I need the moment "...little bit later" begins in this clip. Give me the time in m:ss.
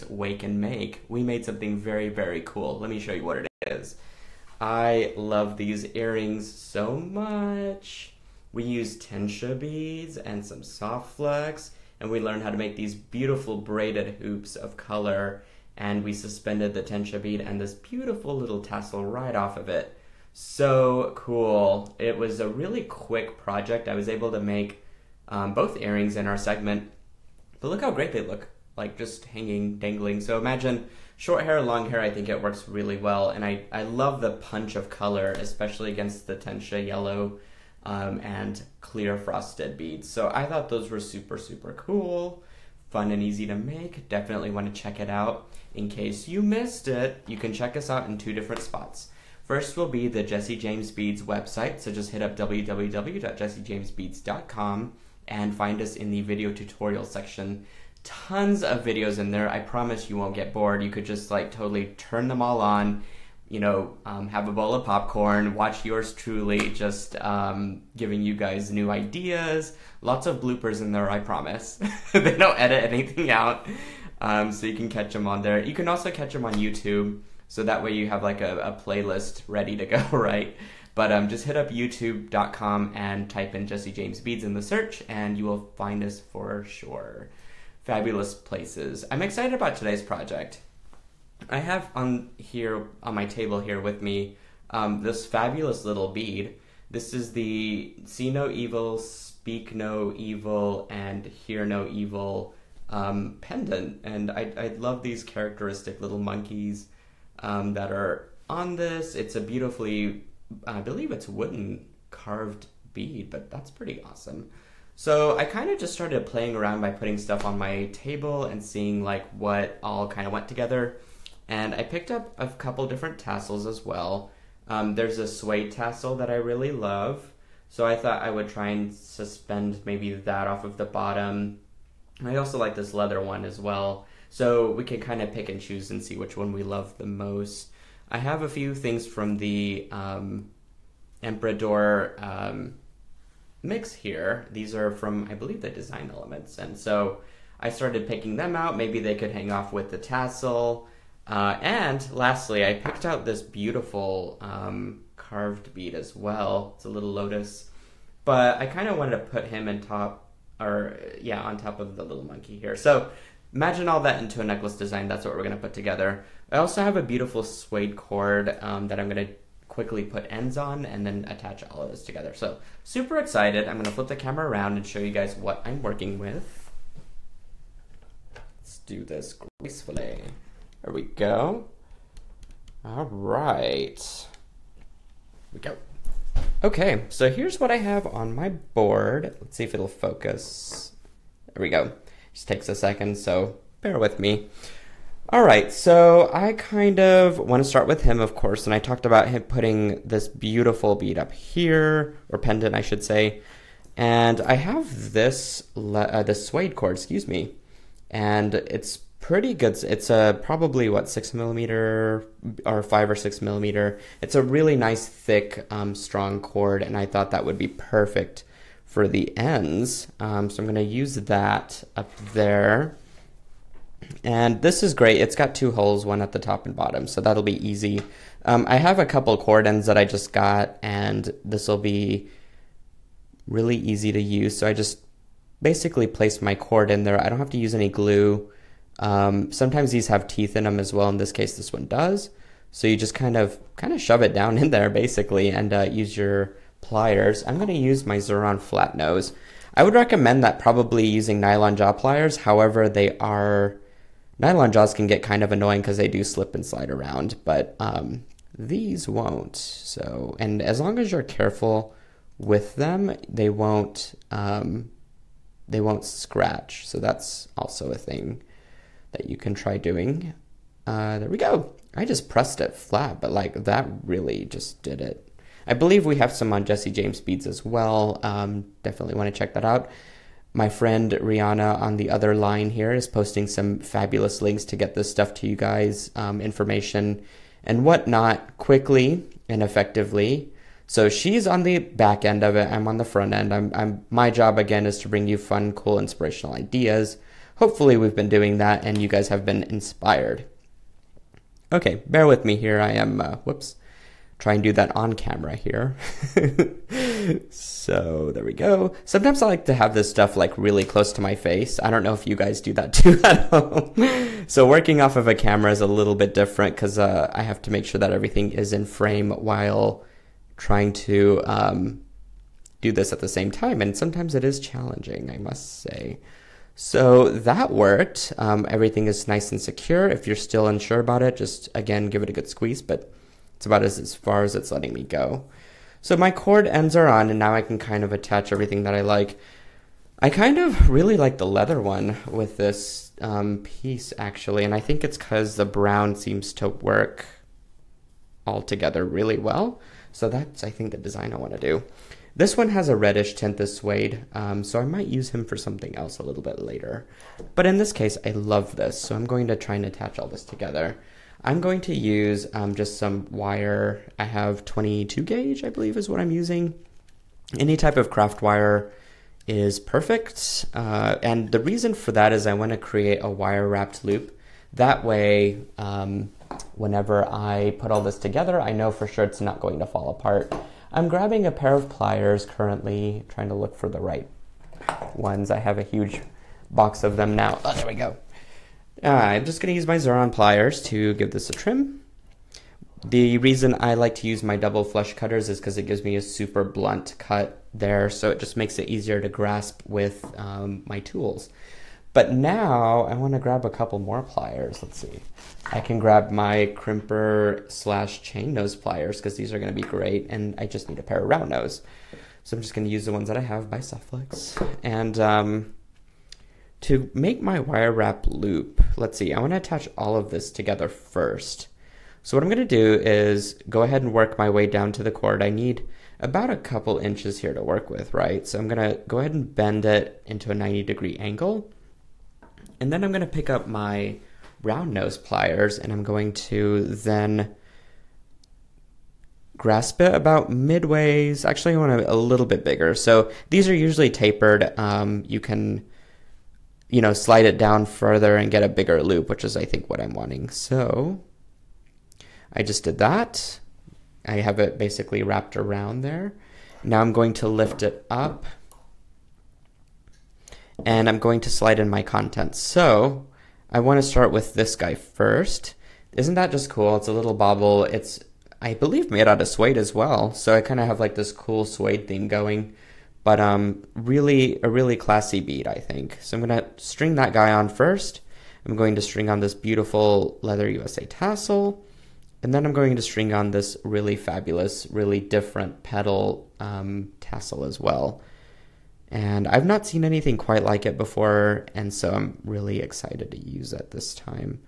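5:56.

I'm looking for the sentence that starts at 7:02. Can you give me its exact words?
So what I'm going to do is go ahead and work my way down to the cord.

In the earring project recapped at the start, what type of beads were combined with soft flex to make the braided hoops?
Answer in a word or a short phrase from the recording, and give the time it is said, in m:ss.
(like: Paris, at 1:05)
Tensha beads, at 0:09.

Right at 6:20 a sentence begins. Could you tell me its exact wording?
I'm grabbing a pair of pliers currently, trying to look for the right ones.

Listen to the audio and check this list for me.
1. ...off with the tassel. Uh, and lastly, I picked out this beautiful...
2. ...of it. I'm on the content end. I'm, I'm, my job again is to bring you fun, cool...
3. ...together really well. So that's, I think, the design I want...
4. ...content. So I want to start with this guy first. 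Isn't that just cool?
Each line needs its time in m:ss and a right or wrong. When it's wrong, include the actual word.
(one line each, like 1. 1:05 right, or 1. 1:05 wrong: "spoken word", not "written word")
1. 2:29 right
2. 4:52 wrong: "front", not "content"
3. 5:48 right
4. 7:42 right.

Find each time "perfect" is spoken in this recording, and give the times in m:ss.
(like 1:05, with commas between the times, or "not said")
3:37, 6:09.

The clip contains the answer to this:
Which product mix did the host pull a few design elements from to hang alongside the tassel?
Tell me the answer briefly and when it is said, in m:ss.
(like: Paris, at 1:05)
Emperador, at 2:21.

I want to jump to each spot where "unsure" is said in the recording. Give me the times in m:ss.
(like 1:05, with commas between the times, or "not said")
5:30.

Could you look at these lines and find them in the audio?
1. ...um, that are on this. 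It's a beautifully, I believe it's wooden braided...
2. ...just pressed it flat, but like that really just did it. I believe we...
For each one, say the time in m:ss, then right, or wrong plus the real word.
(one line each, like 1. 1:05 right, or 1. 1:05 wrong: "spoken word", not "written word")
1. 1:47 wrong: "carved", not "braided"
2. 4:32 right.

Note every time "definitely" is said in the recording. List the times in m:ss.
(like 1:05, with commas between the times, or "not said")
0:44, 4:38.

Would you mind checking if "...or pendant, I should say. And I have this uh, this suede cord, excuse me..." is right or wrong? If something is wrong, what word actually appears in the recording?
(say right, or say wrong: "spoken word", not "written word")
right.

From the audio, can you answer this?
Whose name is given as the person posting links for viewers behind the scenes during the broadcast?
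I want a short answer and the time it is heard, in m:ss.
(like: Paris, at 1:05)
Rihanna, at 4:41.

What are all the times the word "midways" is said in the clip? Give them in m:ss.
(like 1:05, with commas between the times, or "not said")
7:20.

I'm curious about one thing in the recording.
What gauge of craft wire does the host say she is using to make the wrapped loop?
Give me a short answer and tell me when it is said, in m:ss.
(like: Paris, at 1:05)
22 gauge, at 6:04.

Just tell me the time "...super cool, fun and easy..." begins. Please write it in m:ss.
0:41.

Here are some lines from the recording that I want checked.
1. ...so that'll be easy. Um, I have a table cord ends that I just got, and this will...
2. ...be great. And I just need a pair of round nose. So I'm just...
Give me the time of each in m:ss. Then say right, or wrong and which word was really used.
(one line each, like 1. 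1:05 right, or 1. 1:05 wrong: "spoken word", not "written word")
1. 3:47 wrong: "couple", not "table"
2. 6:49 right.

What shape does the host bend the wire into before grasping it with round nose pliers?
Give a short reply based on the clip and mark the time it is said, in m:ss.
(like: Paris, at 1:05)
90 degree angle, at 7:10.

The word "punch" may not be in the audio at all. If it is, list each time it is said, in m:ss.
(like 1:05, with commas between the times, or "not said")
0:34.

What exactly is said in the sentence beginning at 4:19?
So, and as long as you're careful with them, they won't um, they won't scratch.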